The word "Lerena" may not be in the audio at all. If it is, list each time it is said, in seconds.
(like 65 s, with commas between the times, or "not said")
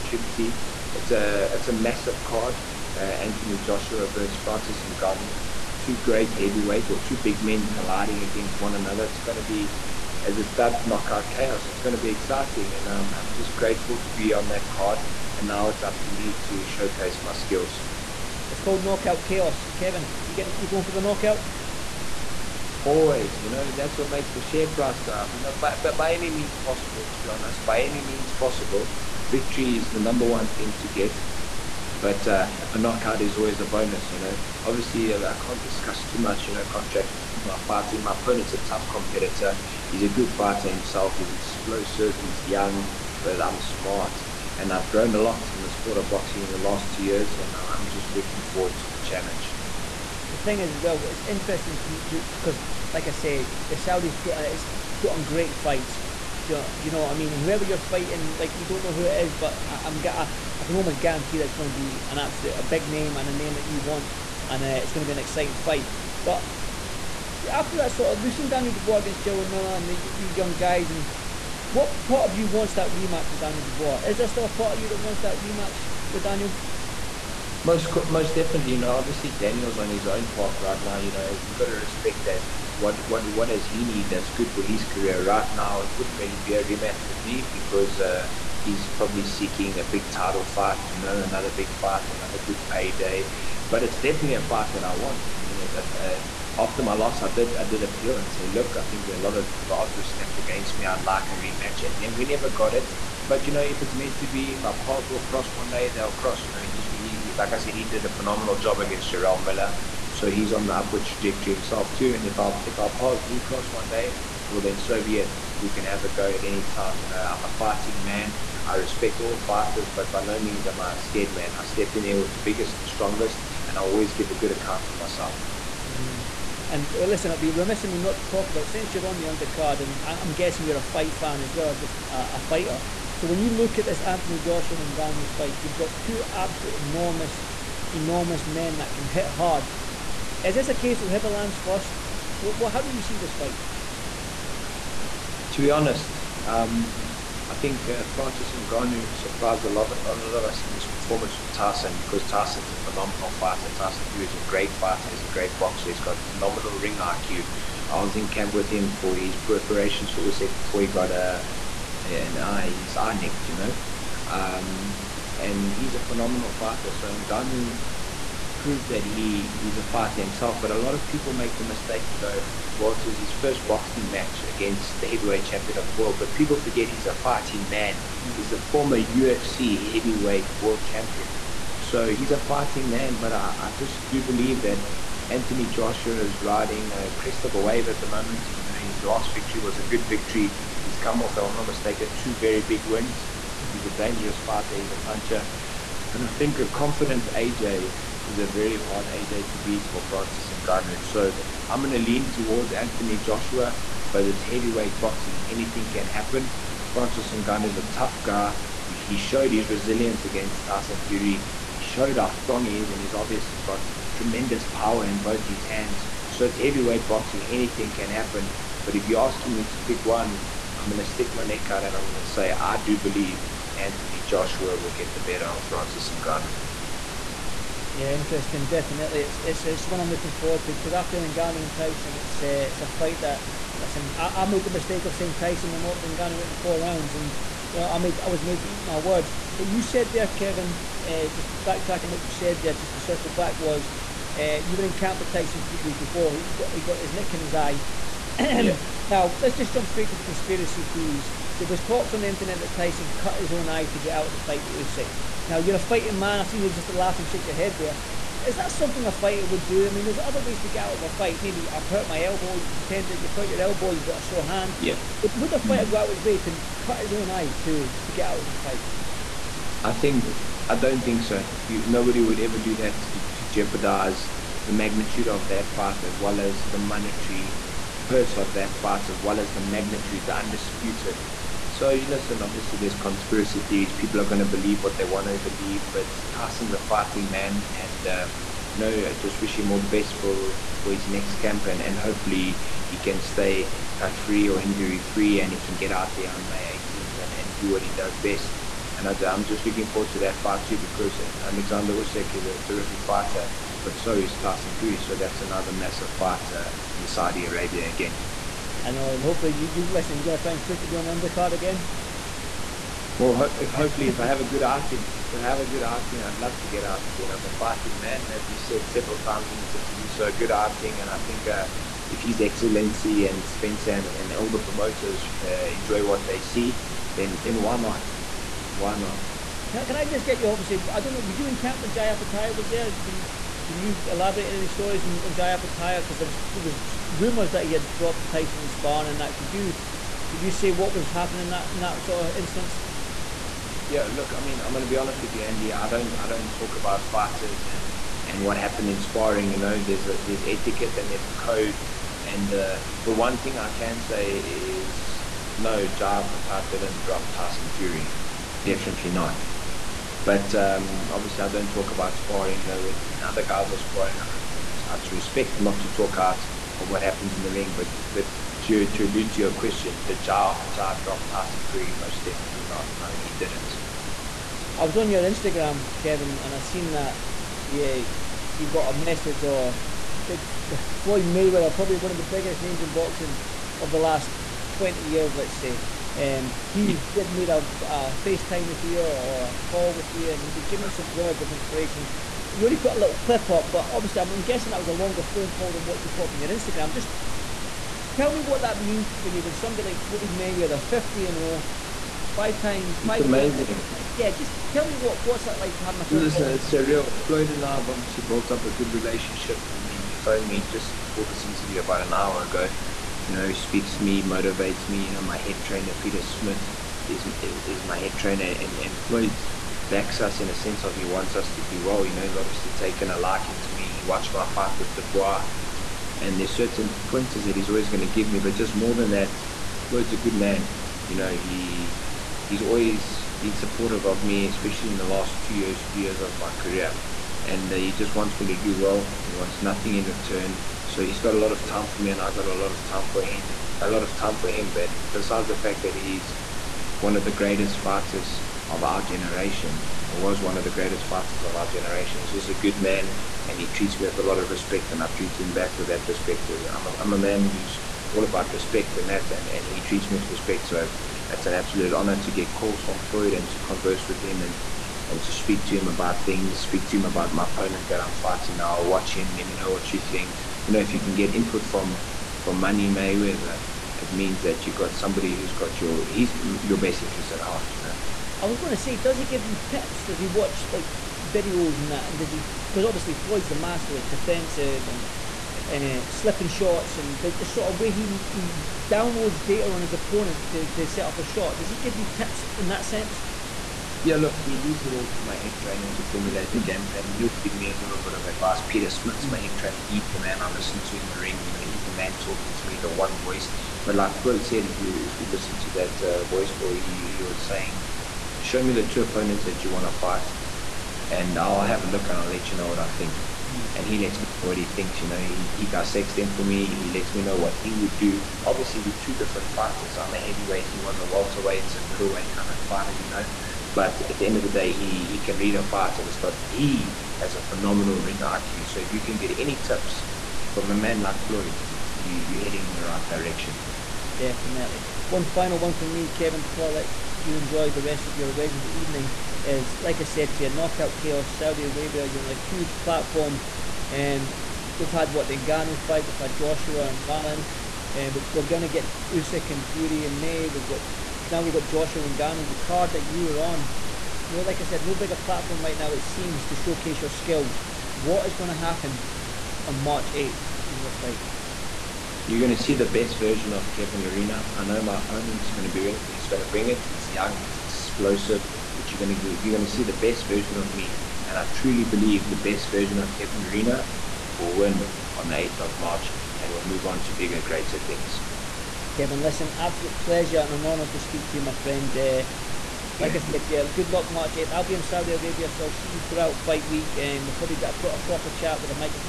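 564 s, 573 s.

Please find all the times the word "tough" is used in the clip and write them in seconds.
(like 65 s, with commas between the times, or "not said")
38 s, 207 s.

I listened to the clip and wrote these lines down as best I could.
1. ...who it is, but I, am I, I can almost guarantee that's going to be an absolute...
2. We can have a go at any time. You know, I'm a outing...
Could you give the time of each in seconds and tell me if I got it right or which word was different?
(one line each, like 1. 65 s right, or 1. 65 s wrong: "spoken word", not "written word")
1. 58 s right
2. 115 s wrong: "fighting", not "outing".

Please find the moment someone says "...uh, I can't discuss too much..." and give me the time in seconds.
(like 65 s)
35 s.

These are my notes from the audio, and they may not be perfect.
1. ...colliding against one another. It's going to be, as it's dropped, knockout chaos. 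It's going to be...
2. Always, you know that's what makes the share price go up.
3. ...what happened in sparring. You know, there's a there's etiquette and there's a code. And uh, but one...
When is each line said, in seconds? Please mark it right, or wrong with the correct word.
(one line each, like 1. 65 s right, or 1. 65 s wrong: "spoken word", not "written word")
1. 7 s wrong: "dubbed", not "dropped"
2. 22 s right
3. 348 s right.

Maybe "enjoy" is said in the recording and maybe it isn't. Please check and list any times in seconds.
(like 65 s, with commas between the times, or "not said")
325 s, 537 s.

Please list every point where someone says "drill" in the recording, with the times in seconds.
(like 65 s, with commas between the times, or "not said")
not said.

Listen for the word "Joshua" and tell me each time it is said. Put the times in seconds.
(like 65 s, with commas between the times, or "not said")
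3 s, 134 s, 185 s, 203 s, 224 s, 546 s, 551 s.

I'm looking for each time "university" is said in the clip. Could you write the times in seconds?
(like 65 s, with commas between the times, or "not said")
not said.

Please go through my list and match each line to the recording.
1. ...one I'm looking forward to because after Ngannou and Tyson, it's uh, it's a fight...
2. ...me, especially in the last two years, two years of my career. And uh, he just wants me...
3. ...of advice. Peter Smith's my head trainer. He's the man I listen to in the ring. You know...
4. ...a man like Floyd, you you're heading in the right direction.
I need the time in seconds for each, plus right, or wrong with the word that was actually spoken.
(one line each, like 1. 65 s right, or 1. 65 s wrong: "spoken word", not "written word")
1. 229 s right
2. 434 s wrong: "three", not "two"
3. 498 s right
4. 530 s right.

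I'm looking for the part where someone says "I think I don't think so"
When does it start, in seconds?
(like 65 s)
269 s.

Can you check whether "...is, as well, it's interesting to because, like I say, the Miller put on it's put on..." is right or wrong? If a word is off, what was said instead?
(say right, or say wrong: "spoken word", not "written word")
wrong: "Saudis", not "Miller".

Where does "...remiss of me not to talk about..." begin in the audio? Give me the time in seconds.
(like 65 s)
127 s.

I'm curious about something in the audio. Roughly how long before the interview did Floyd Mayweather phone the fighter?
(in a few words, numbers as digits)
About an hour.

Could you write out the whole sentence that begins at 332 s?
Can can you elaborate on any stories on, on Jai Opetaia?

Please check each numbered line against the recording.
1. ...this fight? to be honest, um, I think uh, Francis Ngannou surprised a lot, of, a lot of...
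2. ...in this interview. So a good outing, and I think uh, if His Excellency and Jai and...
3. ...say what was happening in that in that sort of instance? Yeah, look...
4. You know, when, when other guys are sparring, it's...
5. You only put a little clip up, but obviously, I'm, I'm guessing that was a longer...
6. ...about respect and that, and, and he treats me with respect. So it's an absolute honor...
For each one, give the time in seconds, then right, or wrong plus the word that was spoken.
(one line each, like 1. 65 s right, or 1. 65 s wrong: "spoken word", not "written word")
1. 143 s right
2. 319 s wrong: "Spencer", not "Jai"
3. 340 s right
4. 362 s right
5. 392 s right
6. 458 s right.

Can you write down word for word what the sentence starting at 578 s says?
Kevin, listen, absolute pleasure and an honour to speak to you, my friend.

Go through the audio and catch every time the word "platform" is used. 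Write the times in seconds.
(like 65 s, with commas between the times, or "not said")
542 s, 555 s.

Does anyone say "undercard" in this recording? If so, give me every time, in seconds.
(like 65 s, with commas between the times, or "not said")
129 s, 311 s.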